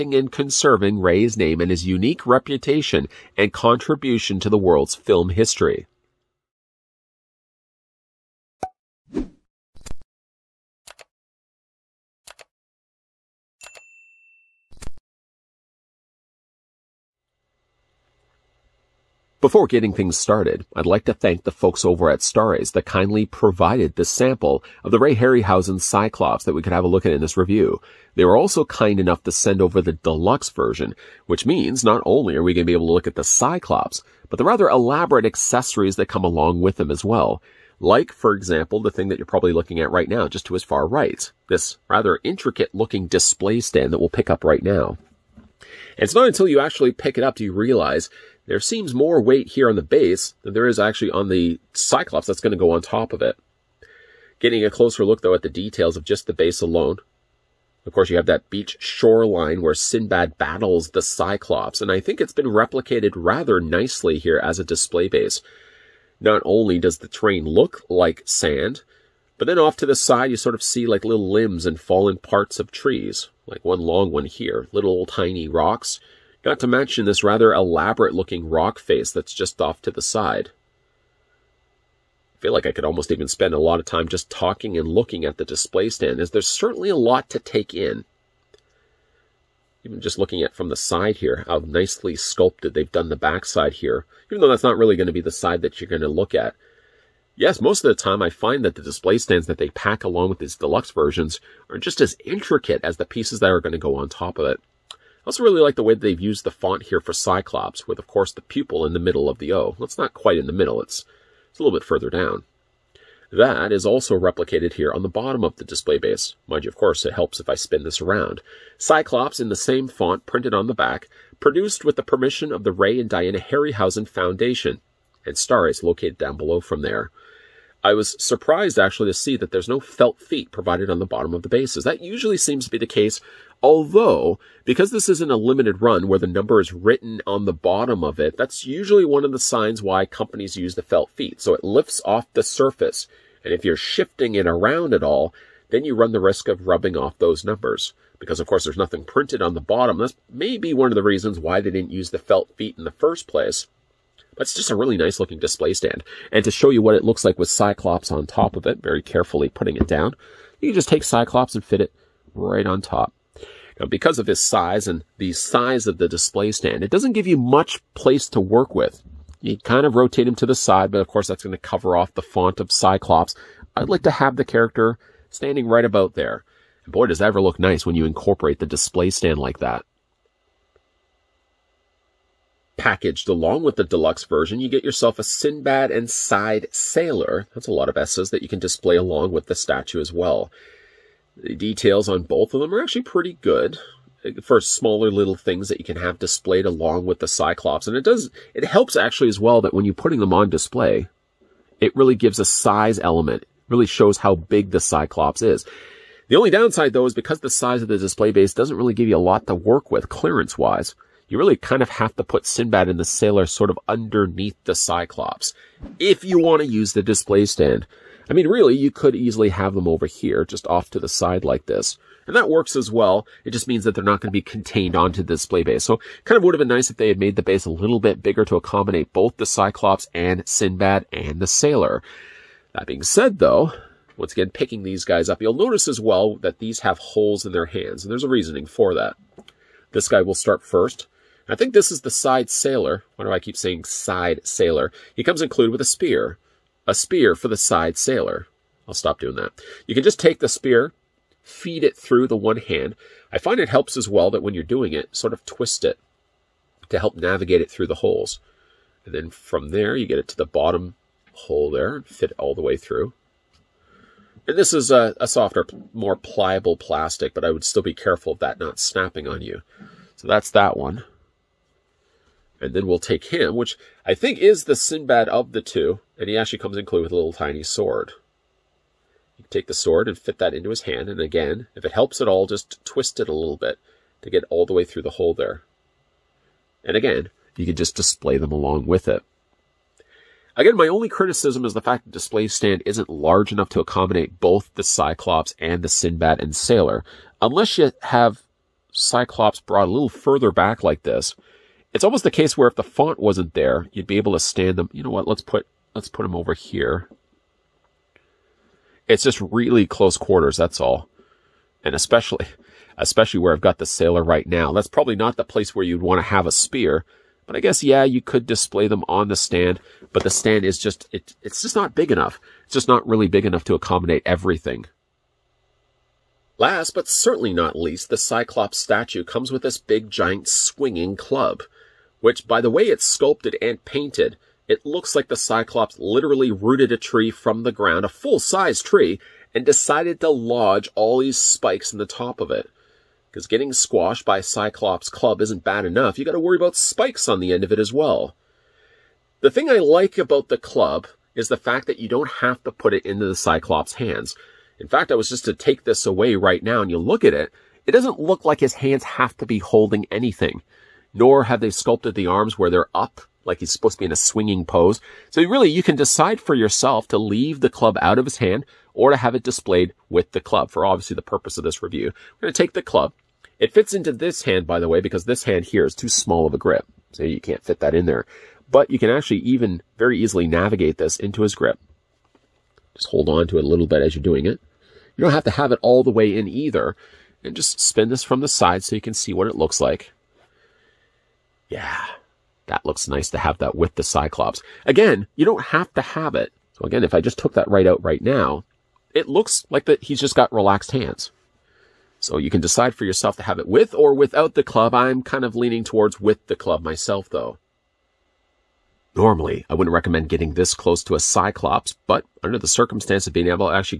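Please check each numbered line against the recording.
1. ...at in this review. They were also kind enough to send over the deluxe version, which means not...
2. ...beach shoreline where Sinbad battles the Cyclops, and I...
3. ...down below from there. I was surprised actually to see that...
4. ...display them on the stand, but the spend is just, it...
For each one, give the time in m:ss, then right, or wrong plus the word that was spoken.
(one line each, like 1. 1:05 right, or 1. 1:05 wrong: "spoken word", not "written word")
1. 0:27 right
2. 0:58 right
3. 2:06 right
4. 5:18 wrong: "stand", not "spend".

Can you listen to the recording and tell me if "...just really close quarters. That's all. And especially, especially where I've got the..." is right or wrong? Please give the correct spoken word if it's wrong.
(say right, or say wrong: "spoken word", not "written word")
right.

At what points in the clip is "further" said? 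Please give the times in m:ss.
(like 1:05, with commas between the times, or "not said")
1:51, 5:00.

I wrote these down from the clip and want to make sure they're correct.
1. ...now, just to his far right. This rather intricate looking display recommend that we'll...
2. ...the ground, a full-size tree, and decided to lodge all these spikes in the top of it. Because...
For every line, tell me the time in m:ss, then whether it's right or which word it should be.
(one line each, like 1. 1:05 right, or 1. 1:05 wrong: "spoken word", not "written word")
1. 0:40 wrong: "stand", not "recommend"
2. 5:37 right.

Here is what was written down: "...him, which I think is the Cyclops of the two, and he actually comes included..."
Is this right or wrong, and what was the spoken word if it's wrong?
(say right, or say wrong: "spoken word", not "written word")
wrong: "Sinbad", not "Cyclops".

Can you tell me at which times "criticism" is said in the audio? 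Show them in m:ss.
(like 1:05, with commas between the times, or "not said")
4:51.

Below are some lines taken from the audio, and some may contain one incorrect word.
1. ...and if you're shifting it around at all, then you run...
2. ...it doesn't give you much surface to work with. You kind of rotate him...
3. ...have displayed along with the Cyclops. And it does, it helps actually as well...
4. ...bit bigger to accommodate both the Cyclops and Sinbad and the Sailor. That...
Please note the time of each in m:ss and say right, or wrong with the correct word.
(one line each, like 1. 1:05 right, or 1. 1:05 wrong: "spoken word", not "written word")
1. 2:23 right
2. 2:46 wrong: "place", not "surface"
3. 3:15 right
4. 3:47 right.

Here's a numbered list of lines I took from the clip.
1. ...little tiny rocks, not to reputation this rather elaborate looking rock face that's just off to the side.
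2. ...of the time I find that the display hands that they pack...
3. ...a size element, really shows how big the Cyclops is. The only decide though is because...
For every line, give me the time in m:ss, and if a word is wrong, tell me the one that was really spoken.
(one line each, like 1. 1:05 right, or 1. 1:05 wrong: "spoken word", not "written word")
1. 1:14 wrong: "mention", not "reputation"
2. 1:37 wrong: "stands", not "hands"
3. 3:22 wrong: "downside", not "decide".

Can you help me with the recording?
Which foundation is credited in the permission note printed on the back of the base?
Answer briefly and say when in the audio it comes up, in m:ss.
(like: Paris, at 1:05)
Ray and Diana Harryhausen Foundation, at 2:02.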